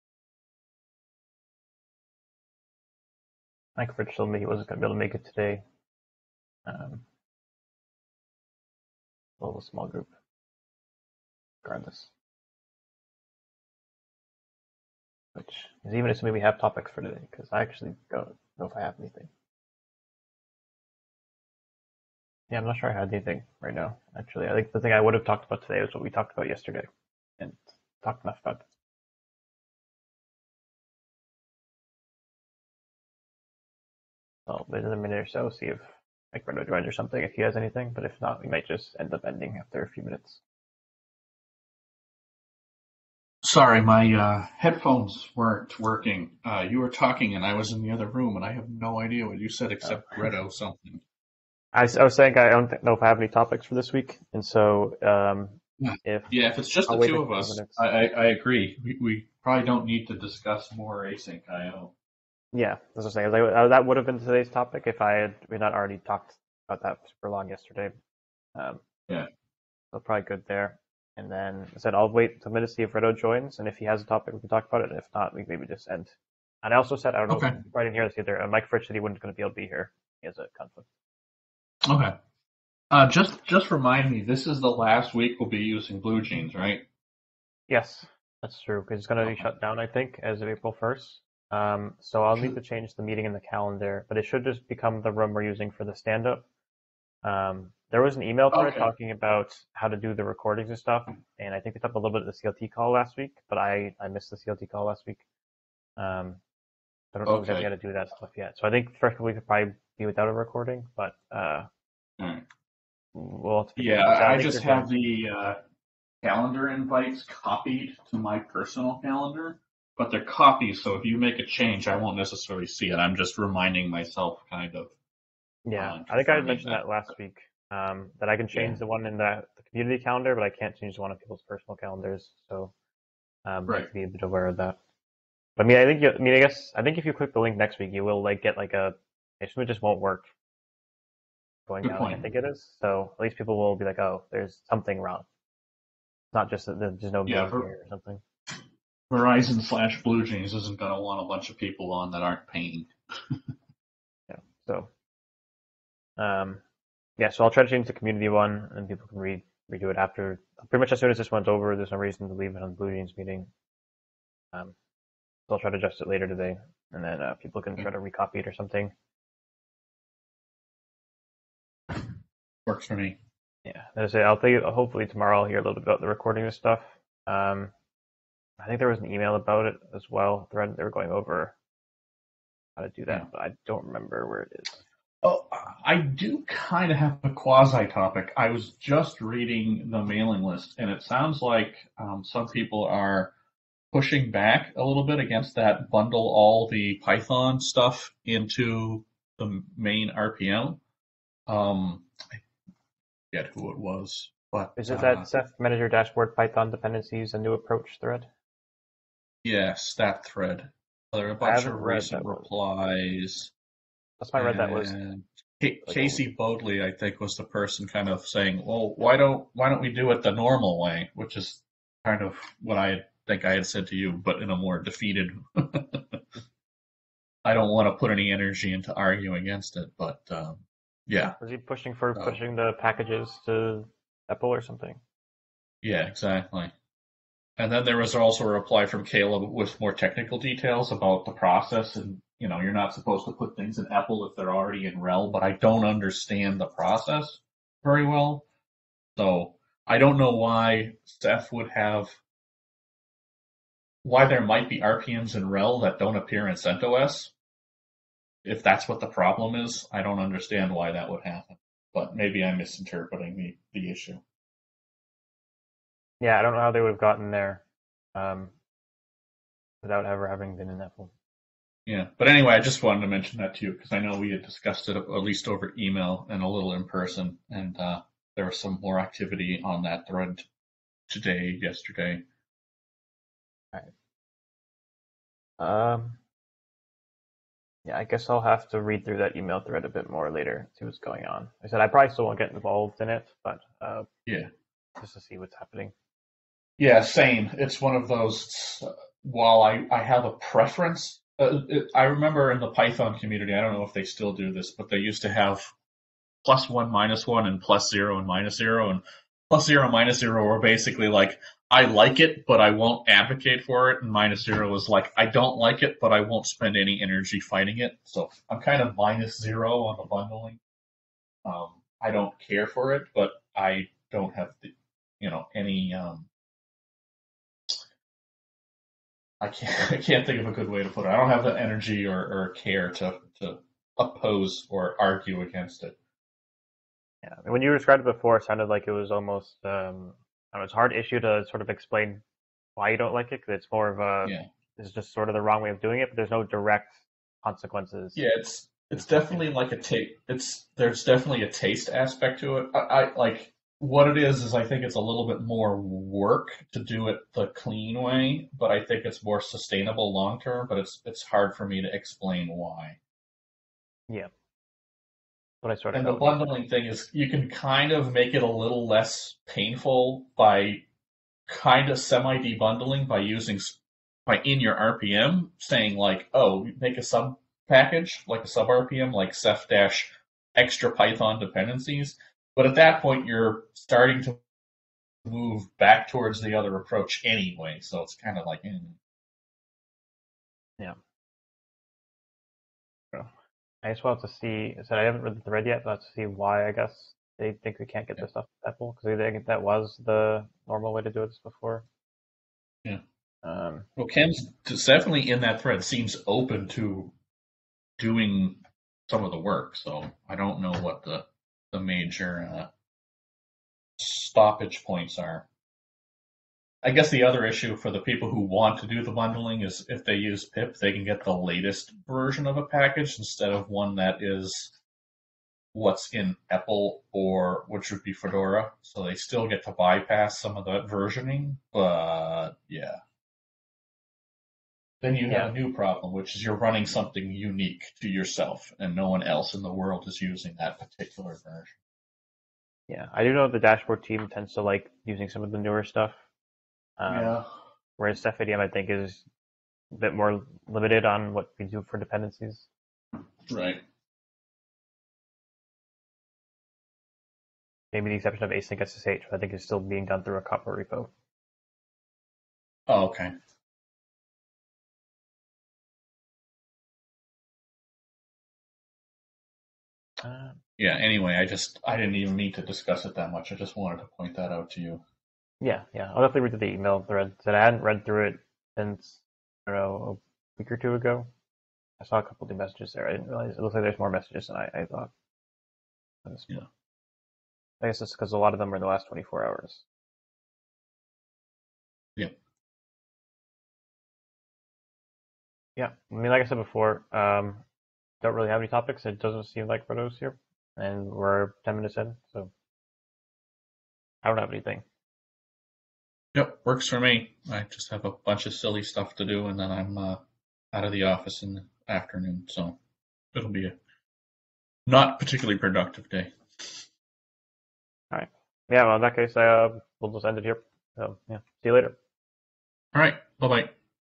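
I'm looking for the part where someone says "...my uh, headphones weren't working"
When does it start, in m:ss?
0:43.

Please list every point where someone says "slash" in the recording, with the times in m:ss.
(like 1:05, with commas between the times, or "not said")
2:29.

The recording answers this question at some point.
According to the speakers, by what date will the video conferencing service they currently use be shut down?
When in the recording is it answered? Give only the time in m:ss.
1:30.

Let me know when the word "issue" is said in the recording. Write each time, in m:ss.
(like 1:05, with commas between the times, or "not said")
4:23, 5:40, 6:57.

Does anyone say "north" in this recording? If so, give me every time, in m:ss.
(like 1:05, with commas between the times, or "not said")
not said.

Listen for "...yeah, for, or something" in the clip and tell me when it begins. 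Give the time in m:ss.
2:27.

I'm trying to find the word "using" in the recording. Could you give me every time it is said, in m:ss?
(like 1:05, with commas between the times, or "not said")
1:25, 1:35, 6:13, 7:20, 7:25.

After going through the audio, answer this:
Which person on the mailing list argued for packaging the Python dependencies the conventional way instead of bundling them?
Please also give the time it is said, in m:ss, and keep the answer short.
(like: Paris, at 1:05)
Casey Bodley, at 3:35.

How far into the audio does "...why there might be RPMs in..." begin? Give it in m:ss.
4:14.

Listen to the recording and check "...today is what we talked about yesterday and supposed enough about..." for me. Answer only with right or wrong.
wrong.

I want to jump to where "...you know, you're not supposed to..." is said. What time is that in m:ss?
4:02.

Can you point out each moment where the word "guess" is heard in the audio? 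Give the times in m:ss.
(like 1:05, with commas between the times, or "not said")
2:16, 4:48, 6:36, 6:56, 8:07.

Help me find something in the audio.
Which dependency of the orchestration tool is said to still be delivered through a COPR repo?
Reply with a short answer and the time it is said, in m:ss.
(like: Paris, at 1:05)
async SSH, at 7:38.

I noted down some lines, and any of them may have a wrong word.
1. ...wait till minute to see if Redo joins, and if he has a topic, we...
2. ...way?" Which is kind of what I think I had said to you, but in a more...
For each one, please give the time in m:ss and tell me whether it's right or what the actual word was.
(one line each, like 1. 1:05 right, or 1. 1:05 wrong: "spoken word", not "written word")
1. 1:12 right
2. 3:40 right.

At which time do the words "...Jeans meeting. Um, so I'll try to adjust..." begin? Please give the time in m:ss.
2:42.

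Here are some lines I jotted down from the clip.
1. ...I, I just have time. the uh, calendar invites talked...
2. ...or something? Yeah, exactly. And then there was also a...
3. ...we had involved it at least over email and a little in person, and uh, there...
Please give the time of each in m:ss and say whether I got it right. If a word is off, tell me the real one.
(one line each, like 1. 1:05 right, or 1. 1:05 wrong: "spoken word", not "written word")
1. 1:54 wrong: "copied", not "talked"
2. 3:54 right
3. 4:34 wrong: "discussed", not "involved".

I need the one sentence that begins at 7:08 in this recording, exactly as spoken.
So they still get to bypass some of that versioning, but yeah then you yeah.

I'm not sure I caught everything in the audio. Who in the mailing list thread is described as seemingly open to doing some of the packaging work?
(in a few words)
Ken.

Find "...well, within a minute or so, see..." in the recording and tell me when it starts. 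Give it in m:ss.
0:34.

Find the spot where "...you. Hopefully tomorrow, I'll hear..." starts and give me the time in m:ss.
2:54.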